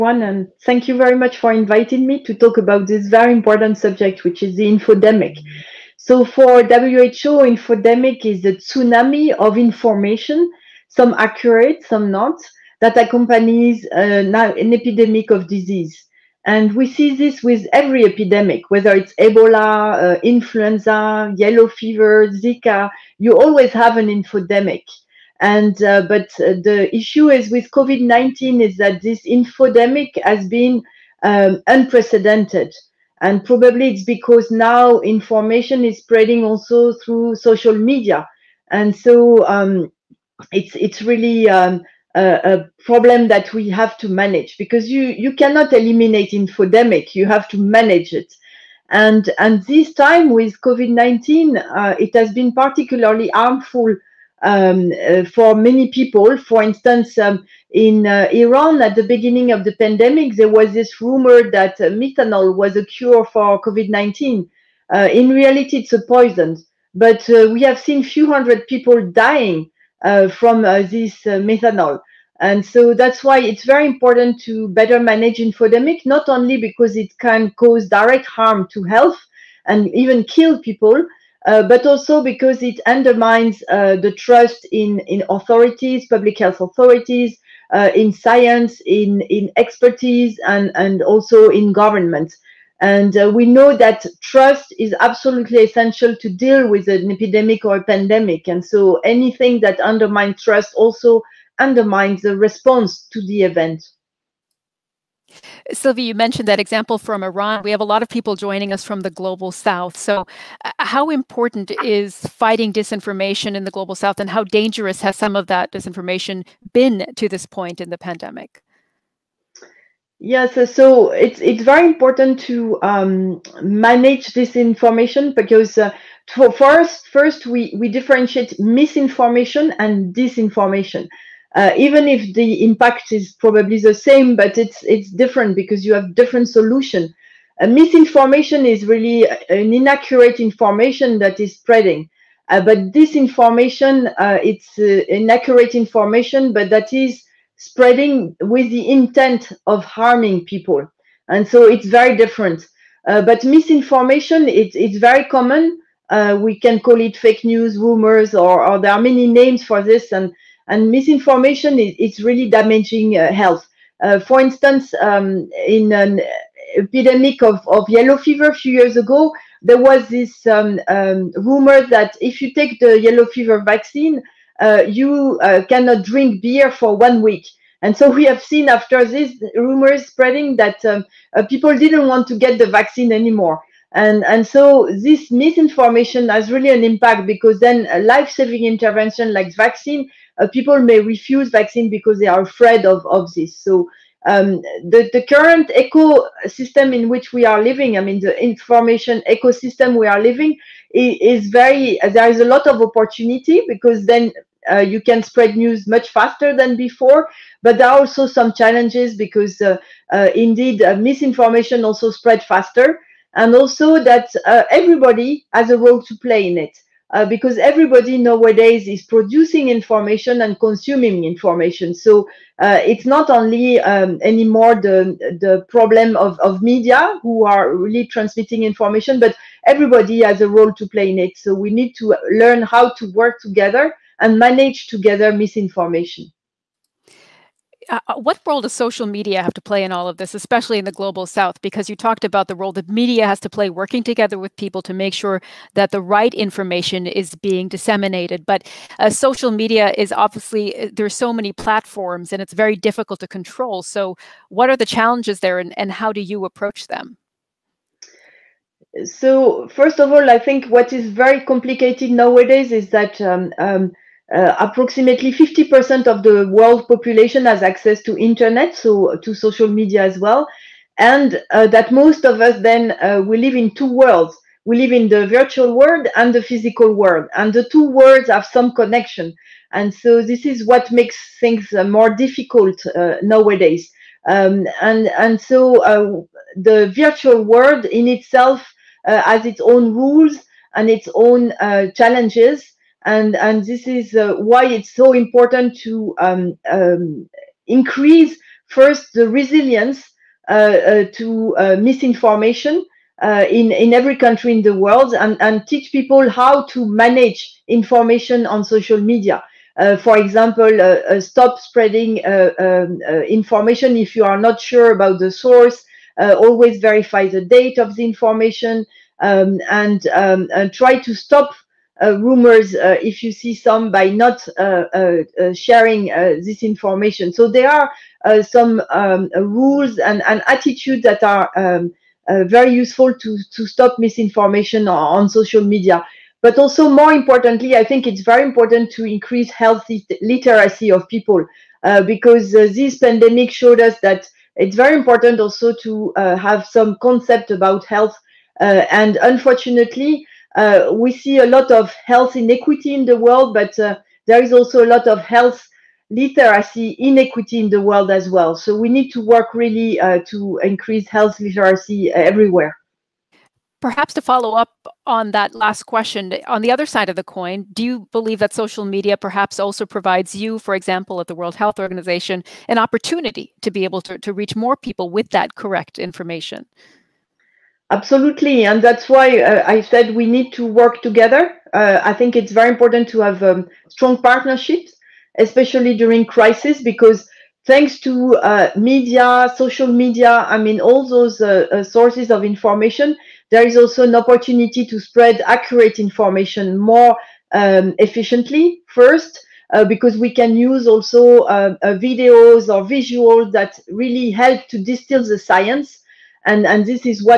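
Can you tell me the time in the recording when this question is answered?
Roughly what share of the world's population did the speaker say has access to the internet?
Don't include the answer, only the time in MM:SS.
04:25.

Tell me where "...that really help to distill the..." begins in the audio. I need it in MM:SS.
06:43.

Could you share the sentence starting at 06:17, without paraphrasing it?
Absolutely, and that's why uh, I said we need to work together.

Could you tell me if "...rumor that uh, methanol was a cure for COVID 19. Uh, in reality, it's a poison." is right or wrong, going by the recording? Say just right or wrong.
right.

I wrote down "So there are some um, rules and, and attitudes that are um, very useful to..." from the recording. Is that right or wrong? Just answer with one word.
right.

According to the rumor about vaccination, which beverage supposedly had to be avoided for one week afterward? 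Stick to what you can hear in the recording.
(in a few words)
beer.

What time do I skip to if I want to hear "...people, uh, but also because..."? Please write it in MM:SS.
01:20.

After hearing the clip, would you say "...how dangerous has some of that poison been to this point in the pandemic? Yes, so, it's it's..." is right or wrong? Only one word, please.
wrong.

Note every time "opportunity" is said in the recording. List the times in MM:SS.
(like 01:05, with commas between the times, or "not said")
03:22, 06:12, 06:34.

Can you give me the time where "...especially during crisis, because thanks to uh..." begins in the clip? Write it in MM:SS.
06:25.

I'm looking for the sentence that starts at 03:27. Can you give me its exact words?
But there are also some challenges because uh, uh, indeed uh, misinformation also spread faster.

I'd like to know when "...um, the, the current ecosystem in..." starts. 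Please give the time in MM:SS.
03:14.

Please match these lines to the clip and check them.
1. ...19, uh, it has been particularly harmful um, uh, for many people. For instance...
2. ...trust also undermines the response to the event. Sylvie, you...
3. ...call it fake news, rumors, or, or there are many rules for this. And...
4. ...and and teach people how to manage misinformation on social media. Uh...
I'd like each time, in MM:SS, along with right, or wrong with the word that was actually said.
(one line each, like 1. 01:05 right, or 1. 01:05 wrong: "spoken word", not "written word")
1. 00:50 right
2. 01:40 right
3. 02:36 wrong: "names", not "rules"
4. 05:05 wrong: "information", not "misinformation".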